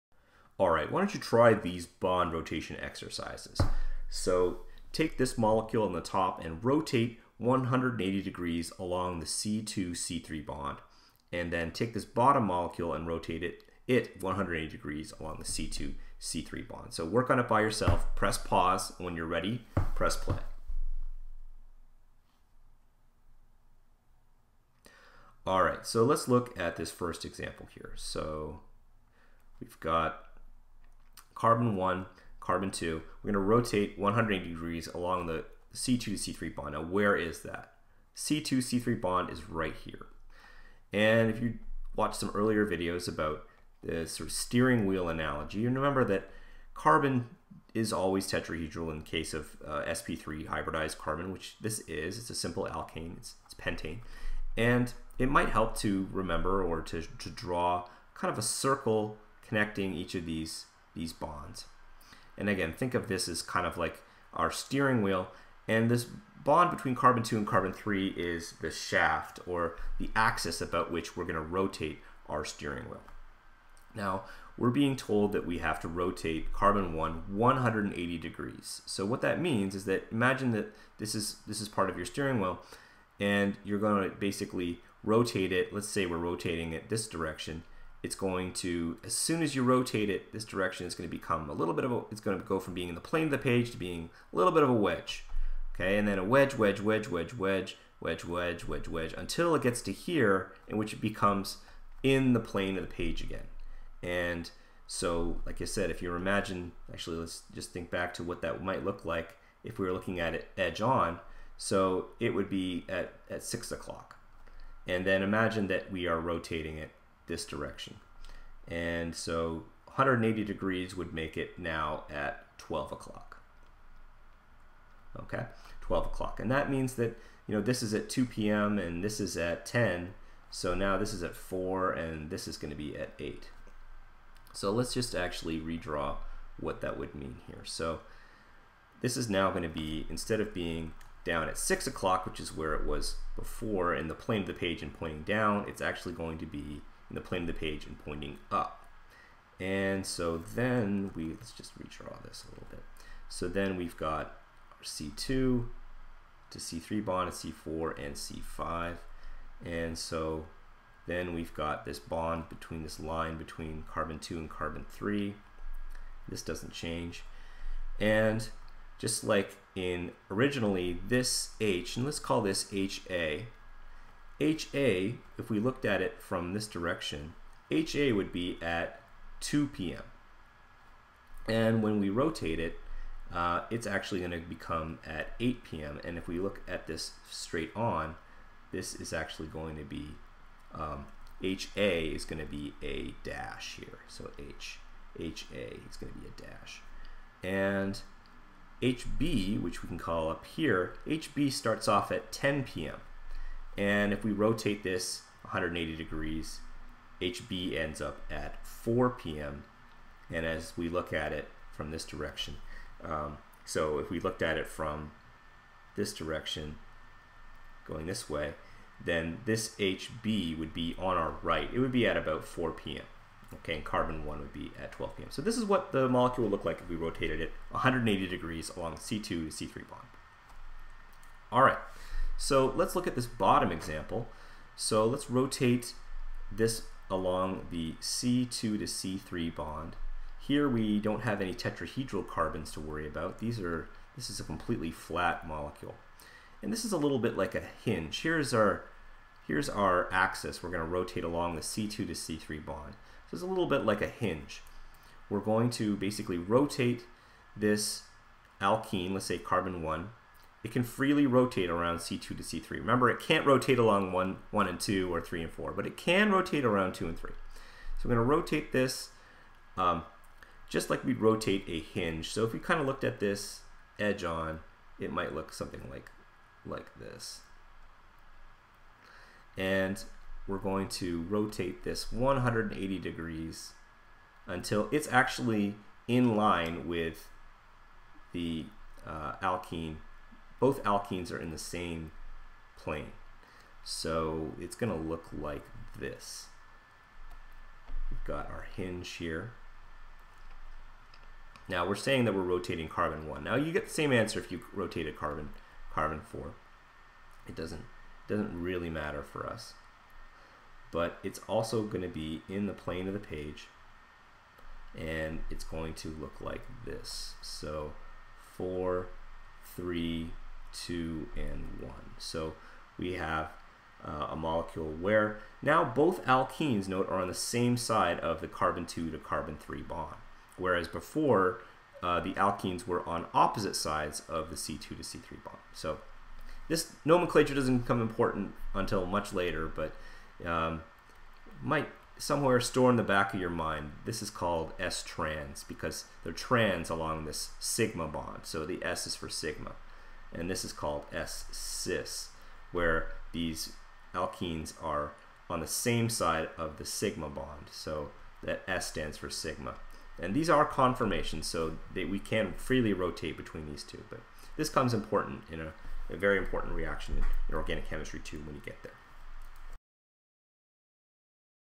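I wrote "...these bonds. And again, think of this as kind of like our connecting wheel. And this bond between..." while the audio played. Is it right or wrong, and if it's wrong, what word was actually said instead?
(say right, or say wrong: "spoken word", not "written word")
wrong: "steering", not "connecting".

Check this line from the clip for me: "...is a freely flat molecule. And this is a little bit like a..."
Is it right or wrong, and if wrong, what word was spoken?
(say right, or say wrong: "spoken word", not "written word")
wrong: "completely", not "freely".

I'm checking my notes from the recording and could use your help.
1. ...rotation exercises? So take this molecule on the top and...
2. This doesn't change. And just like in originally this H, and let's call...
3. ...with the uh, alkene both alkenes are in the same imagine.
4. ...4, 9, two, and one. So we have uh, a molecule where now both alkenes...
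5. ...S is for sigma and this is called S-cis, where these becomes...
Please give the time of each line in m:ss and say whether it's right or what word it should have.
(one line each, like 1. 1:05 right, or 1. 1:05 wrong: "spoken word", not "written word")
1. 0:02 right
2. 2:46 right
3. 4:46 wrong: "plane", not "imagine"
4. 5:18 wrong: "3", not "9"
5. 5:48 wrong: "alkenes", not "becomes".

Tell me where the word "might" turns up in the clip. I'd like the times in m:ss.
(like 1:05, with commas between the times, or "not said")
0:55, 1:48, 4:35, 5:41.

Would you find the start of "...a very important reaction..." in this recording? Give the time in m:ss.
6:06.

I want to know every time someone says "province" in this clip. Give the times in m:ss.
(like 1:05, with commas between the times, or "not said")
not said.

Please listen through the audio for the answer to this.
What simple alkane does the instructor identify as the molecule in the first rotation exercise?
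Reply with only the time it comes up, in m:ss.
0:53.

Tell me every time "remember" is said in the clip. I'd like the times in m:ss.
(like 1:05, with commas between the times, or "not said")
0:45, 0:56, 4:22.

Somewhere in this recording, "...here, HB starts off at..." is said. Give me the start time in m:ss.
3:20.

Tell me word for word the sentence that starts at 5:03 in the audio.
Now you get the same answer if you rotated carbon carbon 4.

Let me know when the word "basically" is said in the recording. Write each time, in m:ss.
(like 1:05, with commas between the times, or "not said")
1:24, 4:15.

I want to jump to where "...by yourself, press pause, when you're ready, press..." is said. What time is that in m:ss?
0:17.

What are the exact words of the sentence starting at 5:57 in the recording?
So that S stands for sigma.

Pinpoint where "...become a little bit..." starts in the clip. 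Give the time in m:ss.
1:31.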